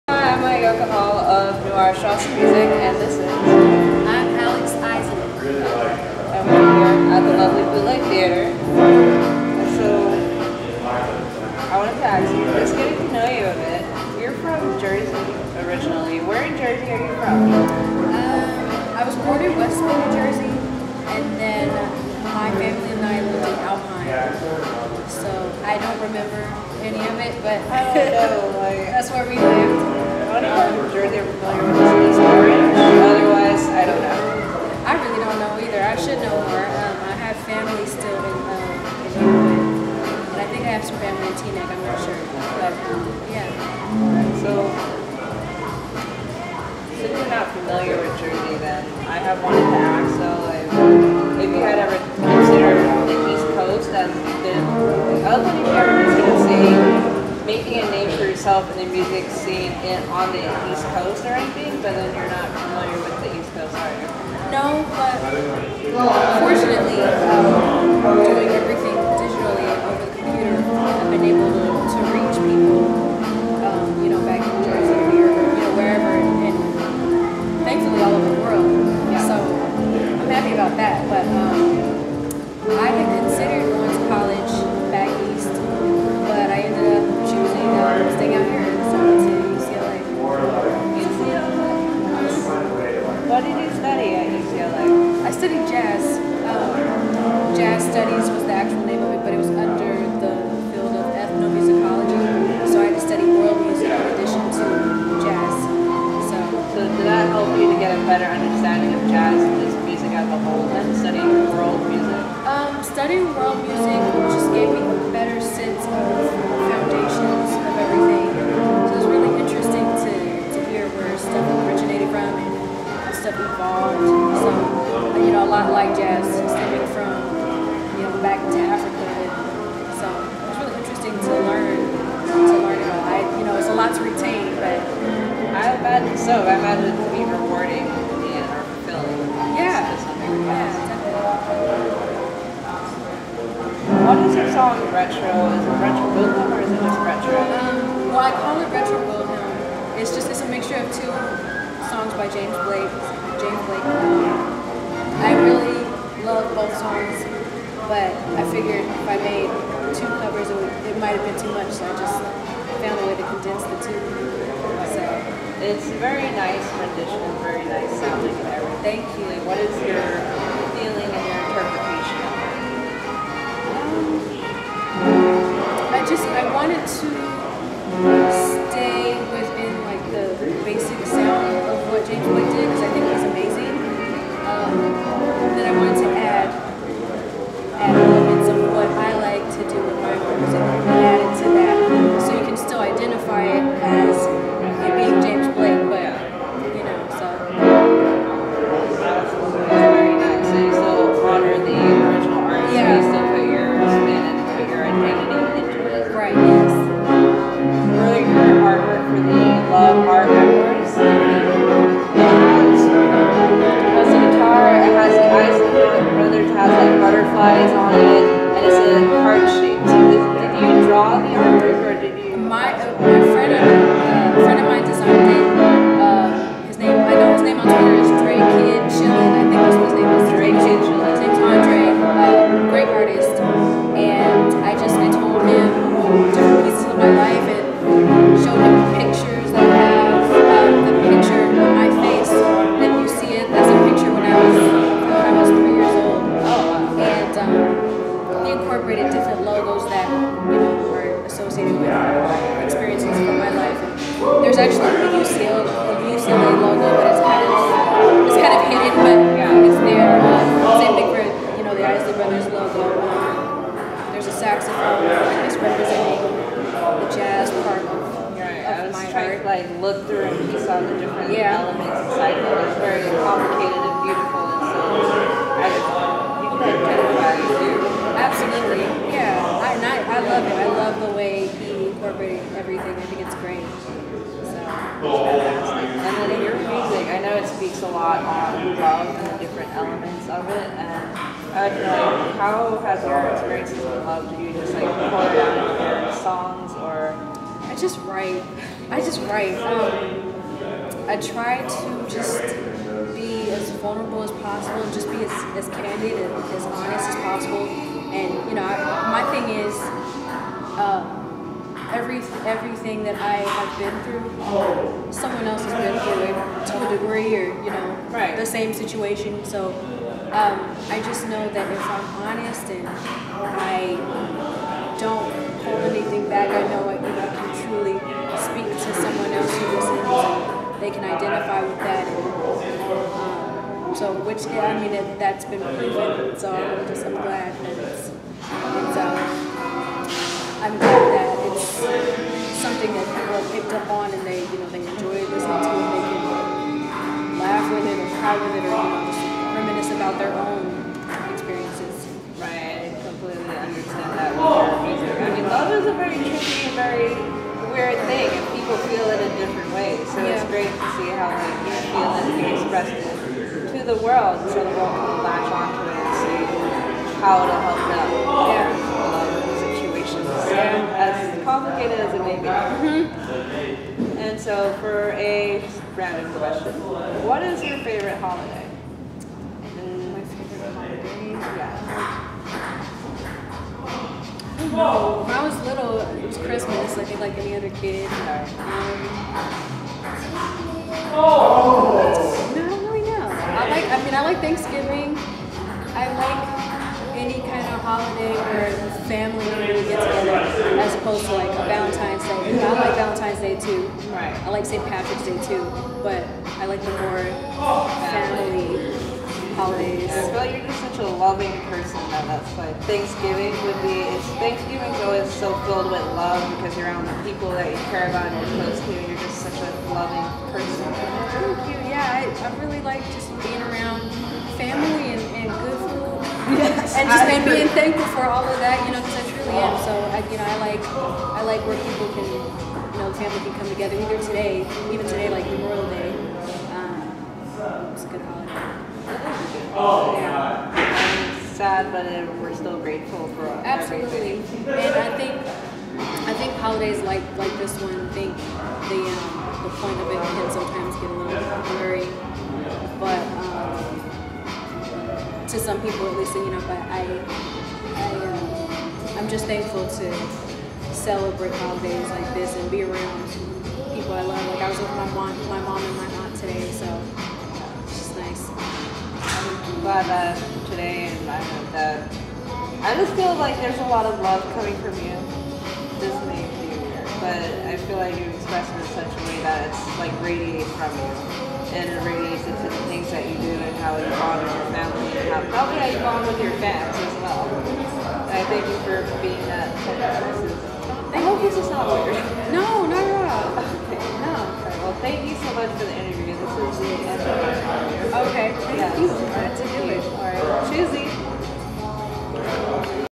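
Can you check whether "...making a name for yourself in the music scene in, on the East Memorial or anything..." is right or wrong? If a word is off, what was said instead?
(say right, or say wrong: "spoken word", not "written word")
wrong: "Coast", not "Memorial".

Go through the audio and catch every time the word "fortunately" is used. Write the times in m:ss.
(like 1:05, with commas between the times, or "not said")
1:06.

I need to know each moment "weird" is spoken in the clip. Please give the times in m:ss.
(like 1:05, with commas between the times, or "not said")
5:57, 7:56, 8:11.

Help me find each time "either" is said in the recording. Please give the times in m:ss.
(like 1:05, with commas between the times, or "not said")
0:35, 7:13.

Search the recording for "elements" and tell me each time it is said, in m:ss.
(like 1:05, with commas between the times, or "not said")
4:31, 4:49.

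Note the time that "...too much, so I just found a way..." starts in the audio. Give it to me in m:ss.
2:41.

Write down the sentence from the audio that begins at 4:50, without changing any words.
And I would know, like, how has your experiences with love?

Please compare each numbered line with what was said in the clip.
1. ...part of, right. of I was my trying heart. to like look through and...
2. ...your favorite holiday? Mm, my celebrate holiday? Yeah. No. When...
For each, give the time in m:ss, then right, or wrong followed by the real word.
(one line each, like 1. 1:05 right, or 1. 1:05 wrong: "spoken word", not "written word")
1. 4:27 right
2. 6:17 wrong: "favorite", not "celebrate".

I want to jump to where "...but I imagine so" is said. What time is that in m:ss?
2:14.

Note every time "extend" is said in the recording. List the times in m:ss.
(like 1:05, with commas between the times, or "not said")
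not said.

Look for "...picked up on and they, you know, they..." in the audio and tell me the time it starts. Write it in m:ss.
5:43.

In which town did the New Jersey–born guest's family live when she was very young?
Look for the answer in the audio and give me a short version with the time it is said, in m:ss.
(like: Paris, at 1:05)
Alpine, at 0:23.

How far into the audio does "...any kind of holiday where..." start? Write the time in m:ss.
6:37.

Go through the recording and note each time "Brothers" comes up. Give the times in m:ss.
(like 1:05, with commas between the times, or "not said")
4:22.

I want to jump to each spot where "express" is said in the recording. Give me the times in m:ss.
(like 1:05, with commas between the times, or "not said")
6:02, 7:58.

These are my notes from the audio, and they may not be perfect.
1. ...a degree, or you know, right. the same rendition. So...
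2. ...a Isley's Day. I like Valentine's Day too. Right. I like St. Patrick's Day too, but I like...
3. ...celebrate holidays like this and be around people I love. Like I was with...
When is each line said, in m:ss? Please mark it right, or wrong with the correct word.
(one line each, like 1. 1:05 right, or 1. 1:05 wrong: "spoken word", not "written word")
1. 5:16 wrong: "situation", not "rendition"
2. 6:41 wrong: "Valentine", not "Isley"
3. 7:40 right.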